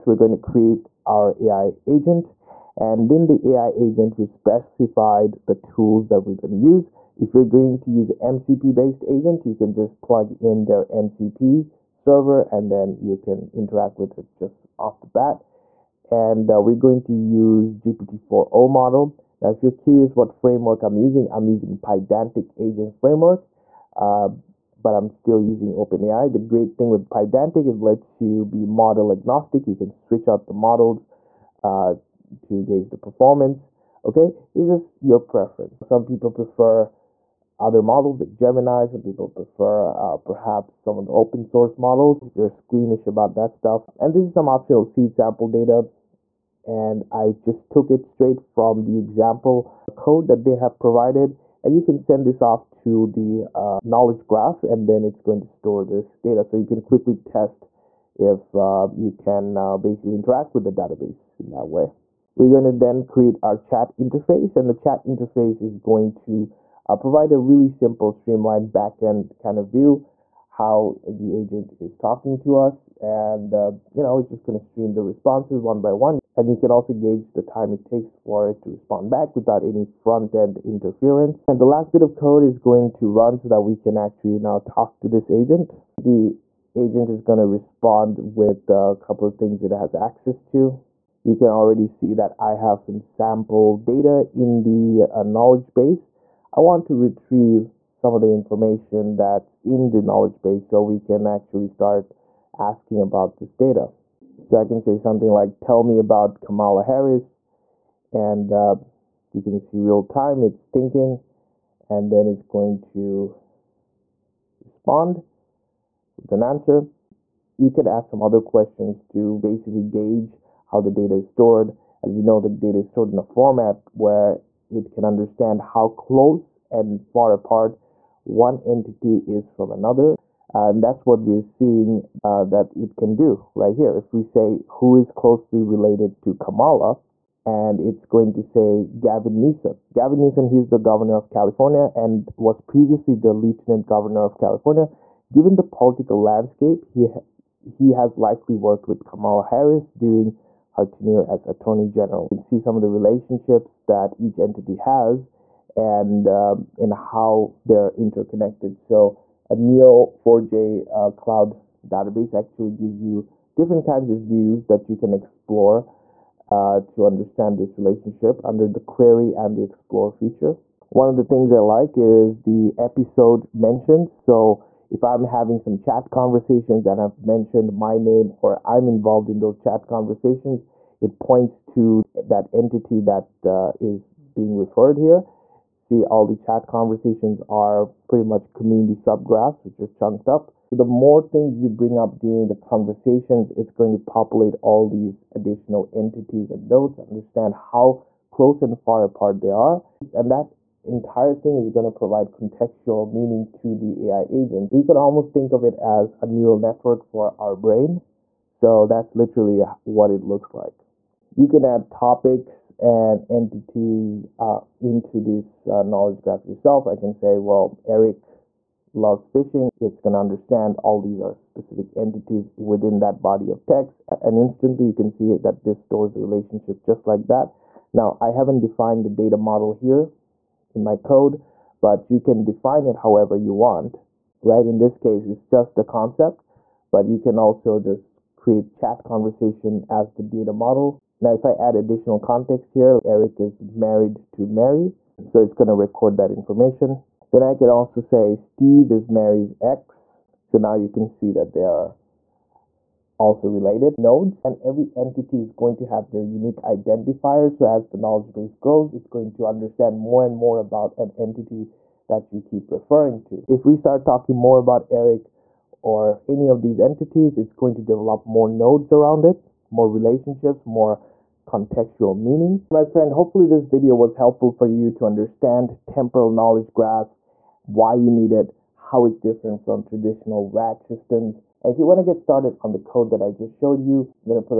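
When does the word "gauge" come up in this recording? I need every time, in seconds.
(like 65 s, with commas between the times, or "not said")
32 s, 76 s, 119 s.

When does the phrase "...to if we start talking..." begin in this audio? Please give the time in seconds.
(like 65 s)
263 s.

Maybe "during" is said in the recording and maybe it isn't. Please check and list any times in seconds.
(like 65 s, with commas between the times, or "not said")
149 s, 192 s.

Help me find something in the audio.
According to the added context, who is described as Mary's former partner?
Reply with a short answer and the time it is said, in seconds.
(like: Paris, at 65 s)
Steve, at 248 s.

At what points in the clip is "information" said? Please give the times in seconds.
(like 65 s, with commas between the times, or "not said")
98 s, 246 s.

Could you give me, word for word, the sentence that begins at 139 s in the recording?
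Gavin Newsom, he's the governor of California and was previously the lieutenant governor of California.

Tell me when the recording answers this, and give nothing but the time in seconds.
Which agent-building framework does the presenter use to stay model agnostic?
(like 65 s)
21 s.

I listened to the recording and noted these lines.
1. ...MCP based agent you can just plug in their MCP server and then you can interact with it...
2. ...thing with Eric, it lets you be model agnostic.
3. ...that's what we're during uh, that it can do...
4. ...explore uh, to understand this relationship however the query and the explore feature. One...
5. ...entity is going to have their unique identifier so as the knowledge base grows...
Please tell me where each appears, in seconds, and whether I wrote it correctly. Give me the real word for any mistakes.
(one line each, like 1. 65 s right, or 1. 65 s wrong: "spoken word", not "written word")
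1. 8 s right
2. 26 s wrong: "Pydantic", not "Eric"
3. 130 s wrong: "seeing", not "during"
4. 165 s wrong: "under", not "however"
5. 254 s right.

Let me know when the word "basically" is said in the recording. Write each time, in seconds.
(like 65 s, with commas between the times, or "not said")
59 s, 119 s.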